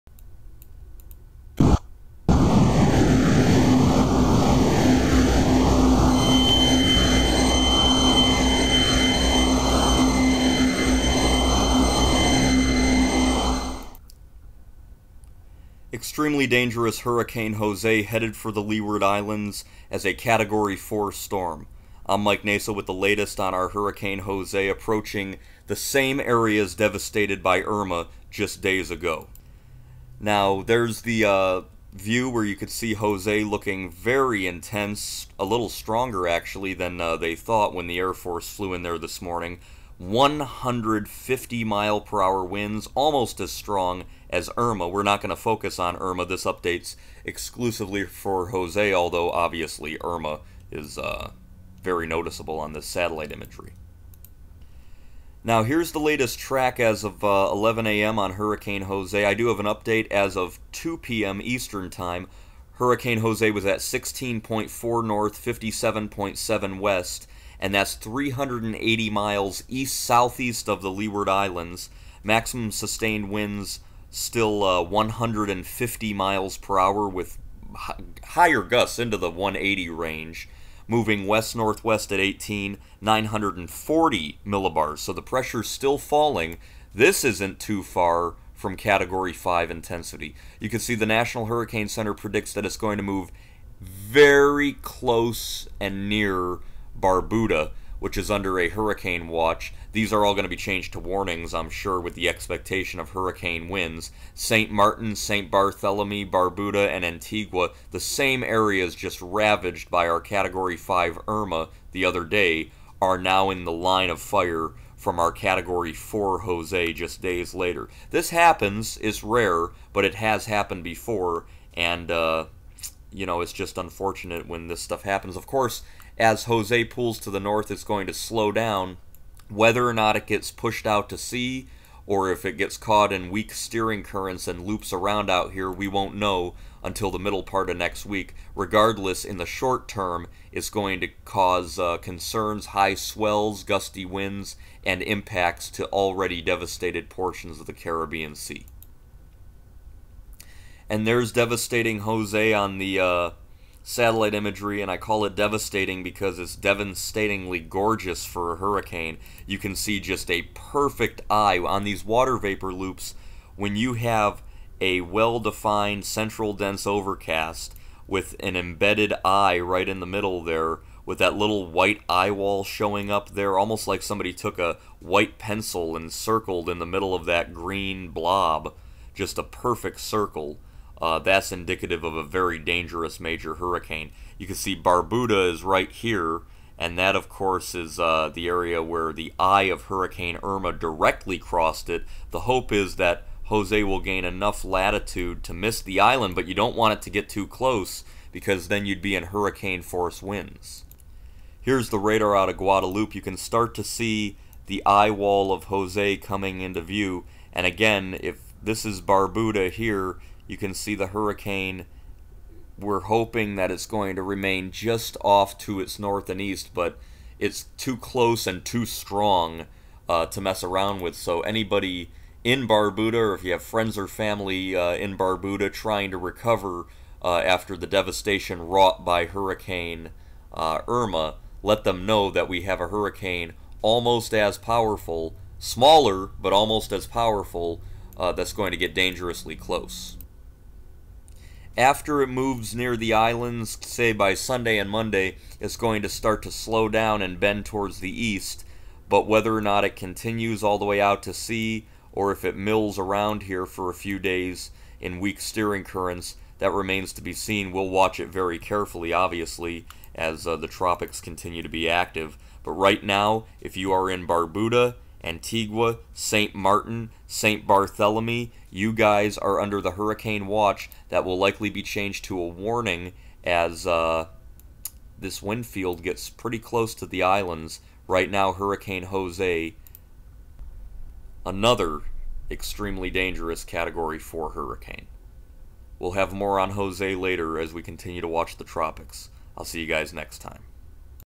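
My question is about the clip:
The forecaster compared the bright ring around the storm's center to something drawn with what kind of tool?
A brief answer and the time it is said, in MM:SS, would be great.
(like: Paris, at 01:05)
white pencil, at 02:54.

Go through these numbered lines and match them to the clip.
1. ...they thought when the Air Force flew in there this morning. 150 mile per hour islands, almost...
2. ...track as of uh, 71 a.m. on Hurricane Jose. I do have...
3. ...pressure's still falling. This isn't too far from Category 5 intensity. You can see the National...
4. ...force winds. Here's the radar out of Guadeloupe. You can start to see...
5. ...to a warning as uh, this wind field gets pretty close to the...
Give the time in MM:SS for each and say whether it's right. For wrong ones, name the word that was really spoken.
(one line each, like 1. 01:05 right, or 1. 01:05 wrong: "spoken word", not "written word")
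1. 00:37 wrong: "winds", not "islands"
2. 00:56 wrong: "11", not "71"
3. 01:25 right
4. 03:19 right
5. 04:32 right.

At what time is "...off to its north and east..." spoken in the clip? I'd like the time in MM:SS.
03:35.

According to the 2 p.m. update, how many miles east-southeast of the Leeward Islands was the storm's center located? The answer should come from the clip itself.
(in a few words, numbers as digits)
380 miles.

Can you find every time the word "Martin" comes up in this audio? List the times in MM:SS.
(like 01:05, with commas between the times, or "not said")
01:44, 04:26.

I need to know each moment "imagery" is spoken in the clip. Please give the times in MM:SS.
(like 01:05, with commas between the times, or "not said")
00:53, 02:34.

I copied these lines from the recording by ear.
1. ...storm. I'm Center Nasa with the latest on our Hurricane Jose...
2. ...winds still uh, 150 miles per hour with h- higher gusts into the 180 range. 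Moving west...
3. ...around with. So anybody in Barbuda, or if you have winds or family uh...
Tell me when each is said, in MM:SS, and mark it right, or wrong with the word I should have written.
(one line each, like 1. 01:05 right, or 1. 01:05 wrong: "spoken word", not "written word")
1. 00:21 wrong: "Mike", not "Center"
2. 01:13 right
3. 03:40 wrong: "friends", not "winds".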